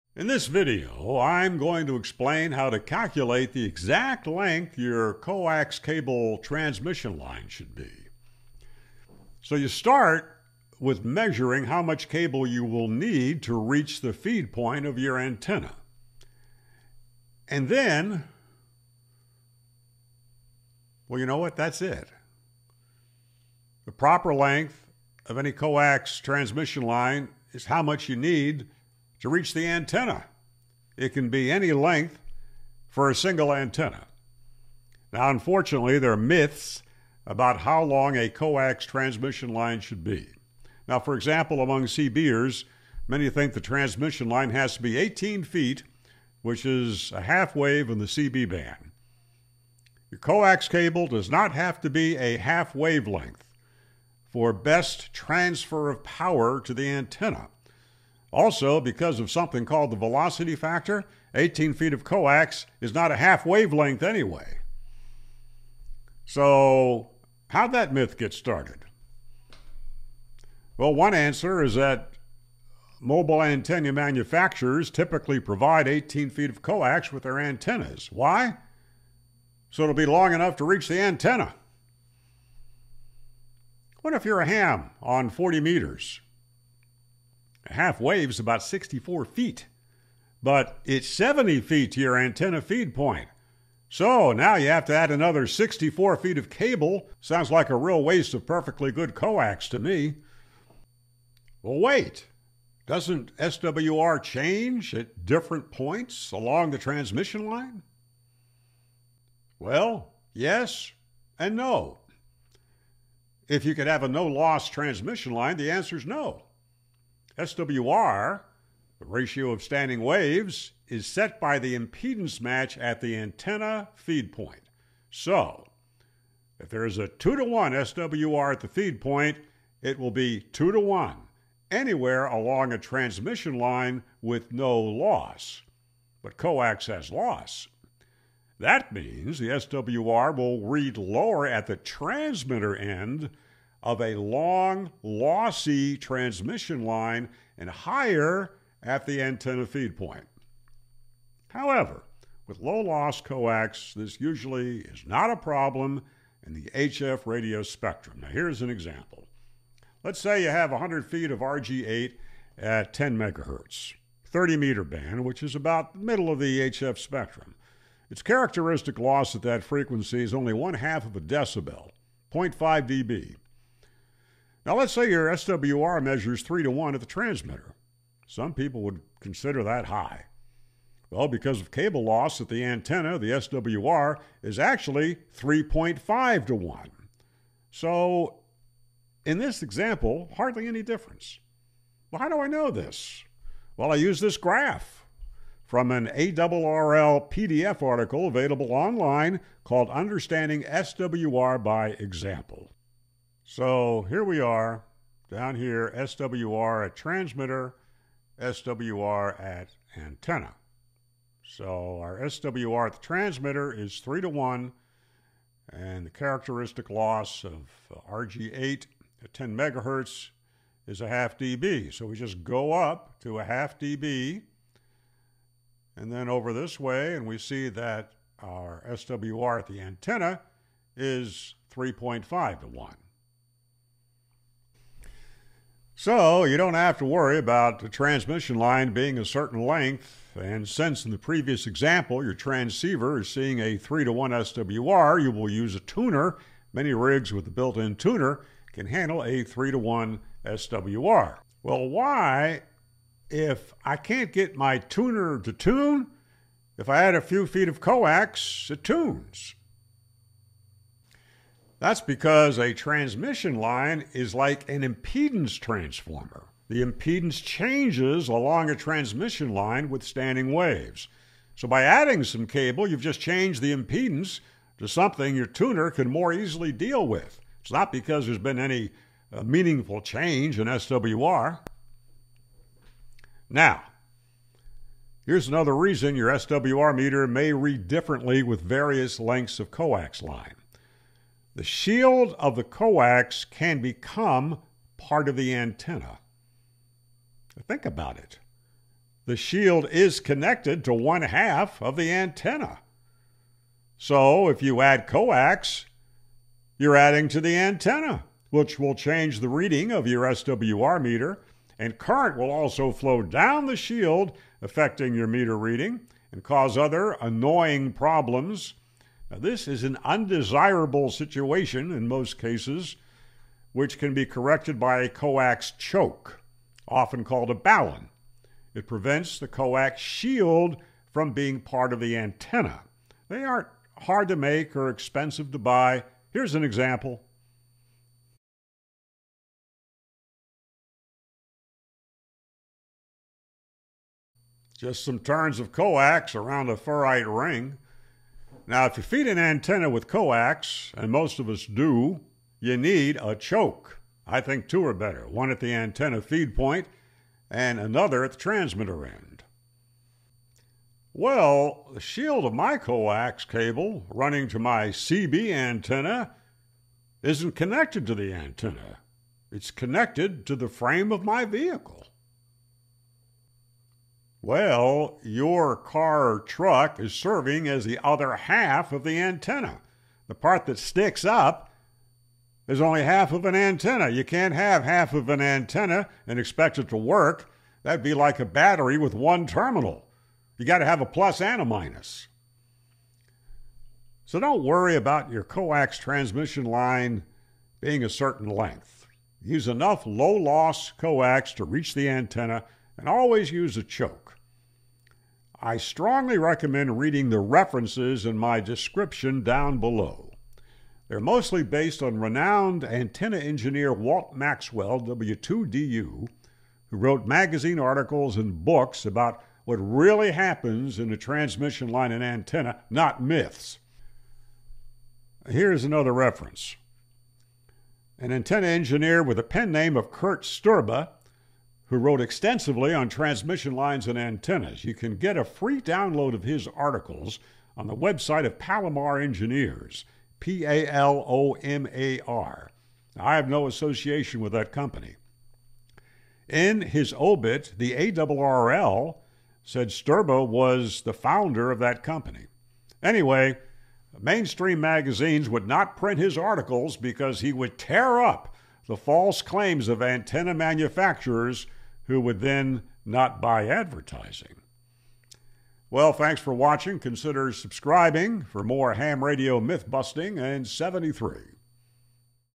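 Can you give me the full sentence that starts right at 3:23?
So here we are down here, SWR at transmitter, SWR at antenna.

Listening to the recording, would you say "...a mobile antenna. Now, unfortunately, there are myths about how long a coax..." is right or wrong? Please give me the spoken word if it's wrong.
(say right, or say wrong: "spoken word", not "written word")
wrong: "single", not "mobile".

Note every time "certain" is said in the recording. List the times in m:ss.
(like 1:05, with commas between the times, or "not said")
3:59, 6:38.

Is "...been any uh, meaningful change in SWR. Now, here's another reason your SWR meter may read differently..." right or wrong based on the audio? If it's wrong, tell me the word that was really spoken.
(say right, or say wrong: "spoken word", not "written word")
right.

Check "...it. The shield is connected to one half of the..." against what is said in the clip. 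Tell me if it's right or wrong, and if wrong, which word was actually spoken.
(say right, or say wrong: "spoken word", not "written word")
right.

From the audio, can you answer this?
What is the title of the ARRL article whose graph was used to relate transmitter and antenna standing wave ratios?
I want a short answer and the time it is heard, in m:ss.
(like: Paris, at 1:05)
Understanding SWR by Example, at 3:19.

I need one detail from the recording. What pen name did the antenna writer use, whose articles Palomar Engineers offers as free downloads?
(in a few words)
Kurt Sterba.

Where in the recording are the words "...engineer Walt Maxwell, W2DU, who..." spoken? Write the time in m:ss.
6:53.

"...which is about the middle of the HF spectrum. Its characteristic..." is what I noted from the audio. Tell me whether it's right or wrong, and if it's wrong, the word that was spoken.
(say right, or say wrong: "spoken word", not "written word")
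right.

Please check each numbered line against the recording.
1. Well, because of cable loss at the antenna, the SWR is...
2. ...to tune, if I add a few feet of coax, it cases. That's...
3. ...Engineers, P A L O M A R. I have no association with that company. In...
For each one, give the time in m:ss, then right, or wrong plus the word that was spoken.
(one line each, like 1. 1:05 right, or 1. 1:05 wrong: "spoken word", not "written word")
1. 3:01 right
2. 4:15 wrong: "tunes", not "cases"
3. 7:19 right.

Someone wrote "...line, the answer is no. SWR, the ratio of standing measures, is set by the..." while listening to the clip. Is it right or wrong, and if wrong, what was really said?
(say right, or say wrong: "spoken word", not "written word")
wrong: "waves", not "measures".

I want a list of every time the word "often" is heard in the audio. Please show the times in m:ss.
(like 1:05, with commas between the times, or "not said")
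5:26.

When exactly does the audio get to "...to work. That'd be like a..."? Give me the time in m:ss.
6:26.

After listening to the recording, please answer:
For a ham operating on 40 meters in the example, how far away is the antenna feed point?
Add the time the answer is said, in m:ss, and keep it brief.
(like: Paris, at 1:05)
70 feet, at 1:31.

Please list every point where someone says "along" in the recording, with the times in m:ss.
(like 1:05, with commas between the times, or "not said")
1:46, 2:12, 4:28.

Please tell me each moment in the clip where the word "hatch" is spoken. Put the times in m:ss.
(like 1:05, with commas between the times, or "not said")
not said.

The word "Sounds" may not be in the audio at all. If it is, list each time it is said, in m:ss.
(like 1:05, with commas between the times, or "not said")
1:37.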